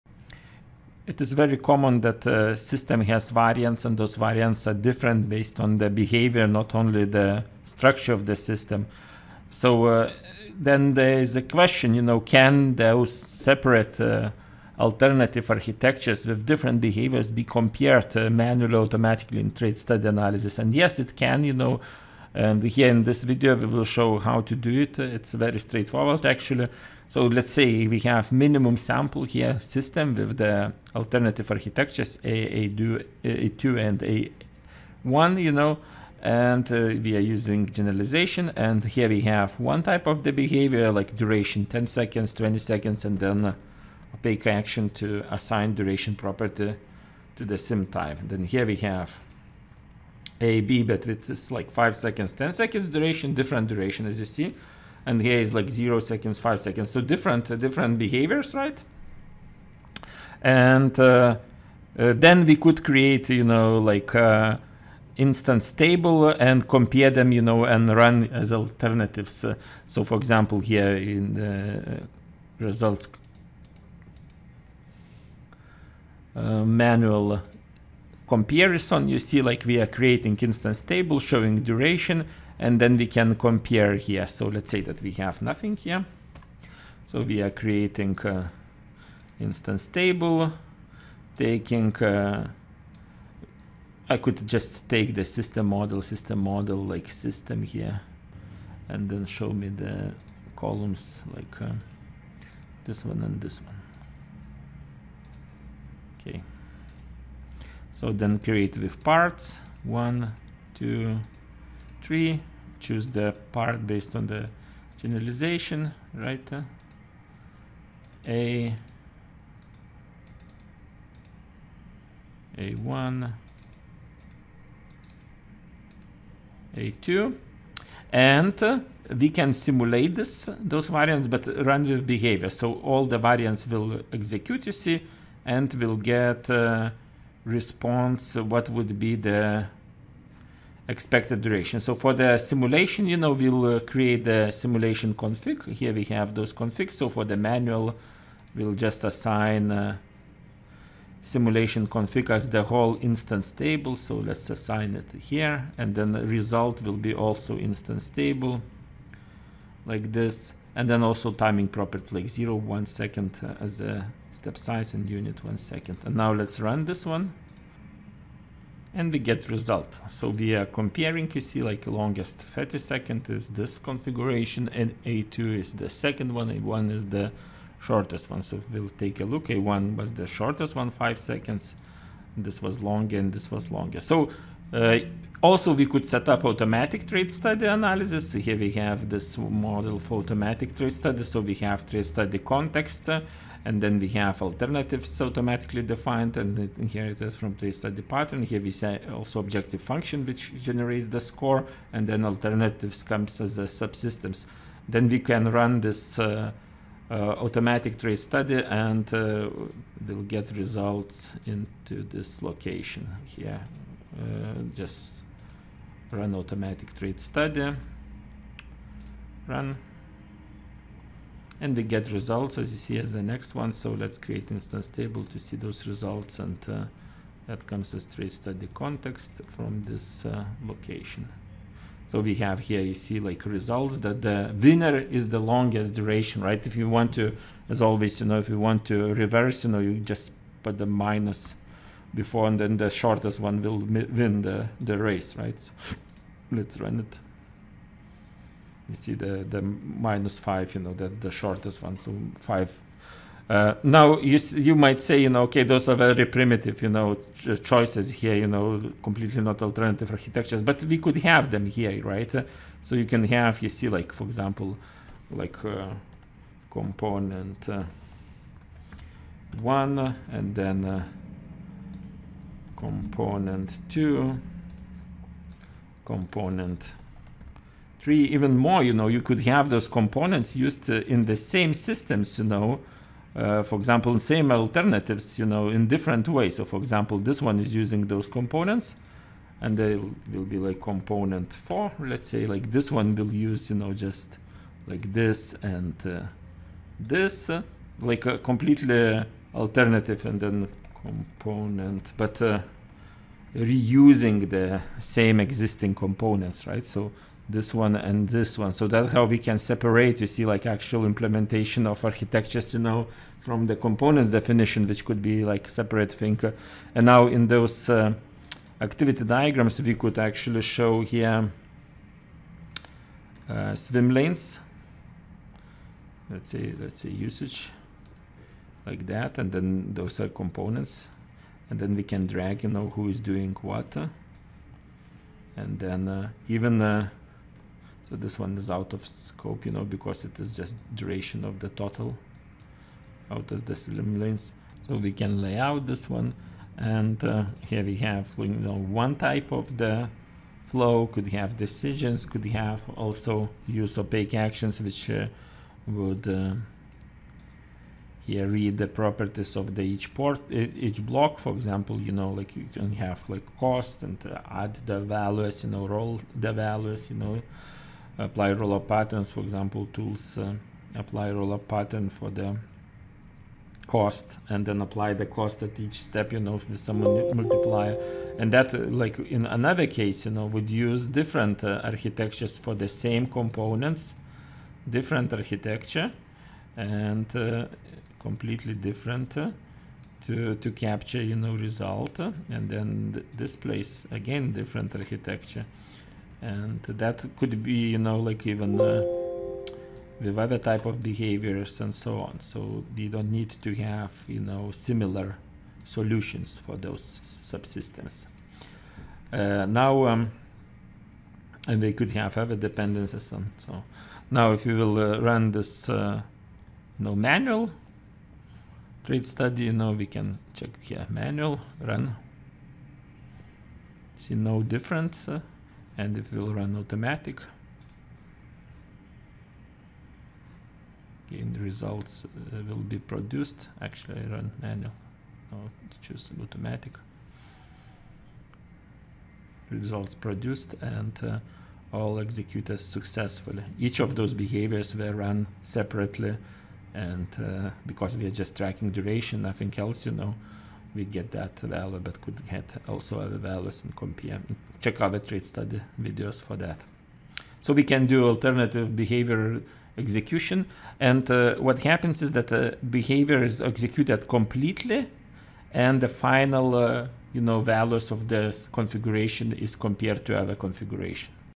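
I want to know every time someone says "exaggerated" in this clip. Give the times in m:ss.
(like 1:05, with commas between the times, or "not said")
not said.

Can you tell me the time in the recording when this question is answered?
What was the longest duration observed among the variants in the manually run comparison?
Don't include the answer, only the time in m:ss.
2:51.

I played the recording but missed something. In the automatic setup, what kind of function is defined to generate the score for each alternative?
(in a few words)
Objective function.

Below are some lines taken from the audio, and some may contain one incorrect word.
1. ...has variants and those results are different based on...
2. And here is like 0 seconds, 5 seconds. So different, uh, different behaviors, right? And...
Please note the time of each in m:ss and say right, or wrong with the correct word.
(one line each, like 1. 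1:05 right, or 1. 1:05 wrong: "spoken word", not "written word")
1. 0:03 wrong: "variants", not "results"
2. 0:55 right.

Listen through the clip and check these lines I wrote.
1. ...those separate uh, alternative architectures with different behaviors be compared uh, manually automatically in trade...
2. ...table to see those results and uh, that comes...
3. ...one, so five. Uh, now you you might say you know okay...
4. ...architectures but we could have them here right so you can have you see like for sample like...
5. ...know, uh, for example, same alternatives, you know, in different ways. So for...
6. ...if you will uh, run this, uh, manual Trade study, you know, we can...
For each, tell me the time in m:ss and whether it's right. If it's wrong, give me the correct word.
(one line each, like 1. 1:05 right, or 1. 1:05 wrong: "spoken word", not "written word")
1. 0:12 right
2. 3:44 right
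3. 4:11 right
4. 4:20 wrong: "example", not "sample"
5. 4:42 right
6. 6:54 right.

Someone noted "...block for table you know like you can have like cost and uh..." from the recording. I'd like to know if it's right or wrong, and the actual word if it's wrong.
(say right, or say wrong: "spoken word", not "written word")
wrong: "example", not "table".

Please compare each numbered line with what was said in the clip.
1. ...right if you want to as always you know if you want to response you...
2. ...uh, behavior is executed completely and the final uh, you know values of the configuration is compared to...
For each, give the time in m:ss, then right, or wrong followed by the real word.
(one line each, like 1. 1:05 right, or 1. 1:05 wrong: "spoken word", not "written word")
1. 3:56 wrong: "reverse", not "response"
2. 7:42 right.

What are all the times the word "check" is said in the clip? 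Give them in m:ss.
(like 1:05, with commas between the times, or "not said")
7:00, 7:34.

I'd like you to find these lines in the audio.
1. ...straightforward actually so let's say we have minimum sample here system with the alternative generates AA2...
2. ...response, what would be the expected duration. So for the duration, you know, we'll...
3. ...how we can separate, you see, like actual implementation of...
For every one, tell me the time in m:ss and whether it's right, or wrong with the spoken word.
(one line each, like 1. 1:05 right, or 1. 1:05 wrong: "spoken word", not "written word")
1. 0:25 wrong: "architectures", not "generates"
2. 2:17 wrong: "simulation", not "duration"
3. 5:09 right.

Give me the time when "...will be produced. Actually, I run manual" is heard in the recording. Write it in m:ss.
7:12.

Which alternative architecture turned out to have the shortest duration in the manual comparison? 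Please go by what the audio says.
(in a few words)
A1.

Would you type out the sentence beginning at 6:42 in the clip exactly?
So we don't need to have, you know, similar solutions for those subsystems.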